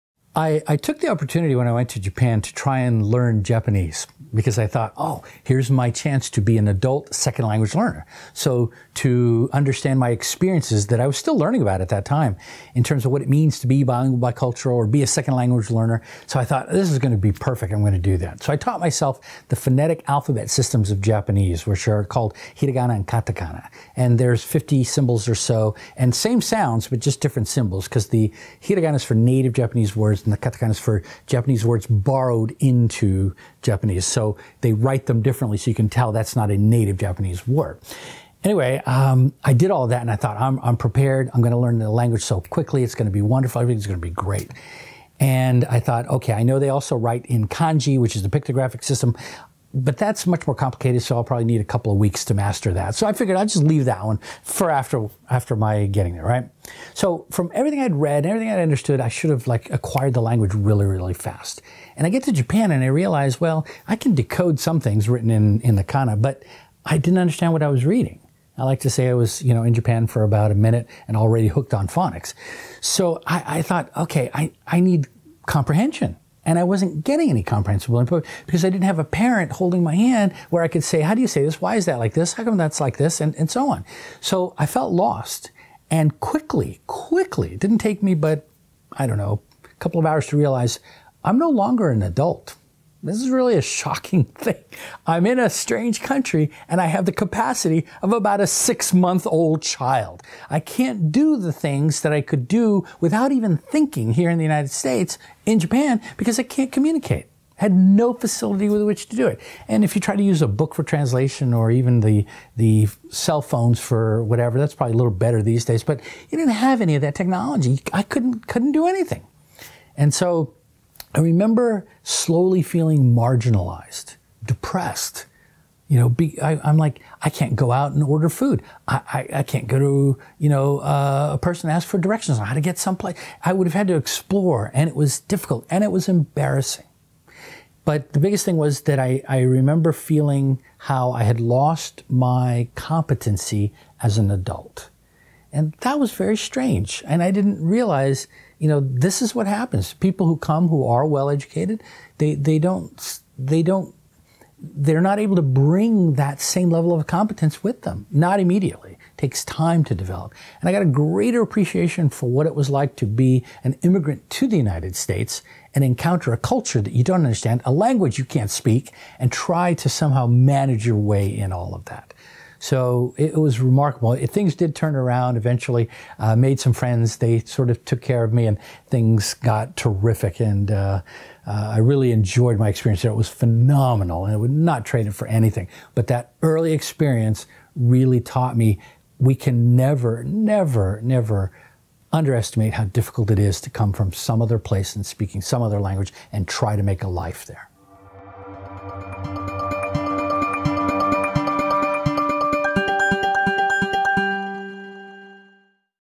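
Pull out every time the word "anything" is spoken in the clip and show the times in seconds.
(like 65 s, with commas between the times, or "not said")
118 s, 185 s.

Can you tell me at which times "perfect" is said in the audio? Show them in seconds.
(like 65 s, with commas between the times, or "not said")
17 s.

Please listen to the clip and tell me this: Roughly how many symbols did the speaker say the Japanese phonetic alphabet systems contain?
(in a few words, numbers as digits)
50.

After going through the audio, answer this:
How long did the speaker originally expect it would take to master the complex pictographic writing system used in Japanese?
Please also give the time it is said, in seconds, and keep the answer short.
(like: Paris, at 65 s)
a couple of weeks, at 51 s.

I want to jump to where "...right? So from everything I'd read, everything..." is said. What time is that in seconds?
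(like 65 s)
56 s.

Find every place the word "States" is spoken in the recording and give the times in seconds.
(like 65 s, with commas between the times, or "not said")
104 s, 164 s.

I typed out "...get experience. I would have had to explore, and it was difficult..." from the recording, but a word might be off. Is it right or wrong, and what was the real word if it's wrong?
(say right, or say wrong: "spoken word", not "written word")
wrong: "someplace", not "experience".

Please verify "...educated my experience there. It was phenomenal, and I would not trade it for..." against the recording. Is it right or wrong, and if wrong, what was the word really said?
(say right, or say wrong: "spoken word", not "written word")
wrong: "enjoyed", not "educated".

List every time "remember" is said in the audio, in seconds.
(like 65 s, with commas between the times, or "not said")
121 s, 139 s.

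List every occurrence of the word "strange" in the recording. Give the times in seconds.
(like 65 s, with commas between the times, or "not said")
95 s, 146 s.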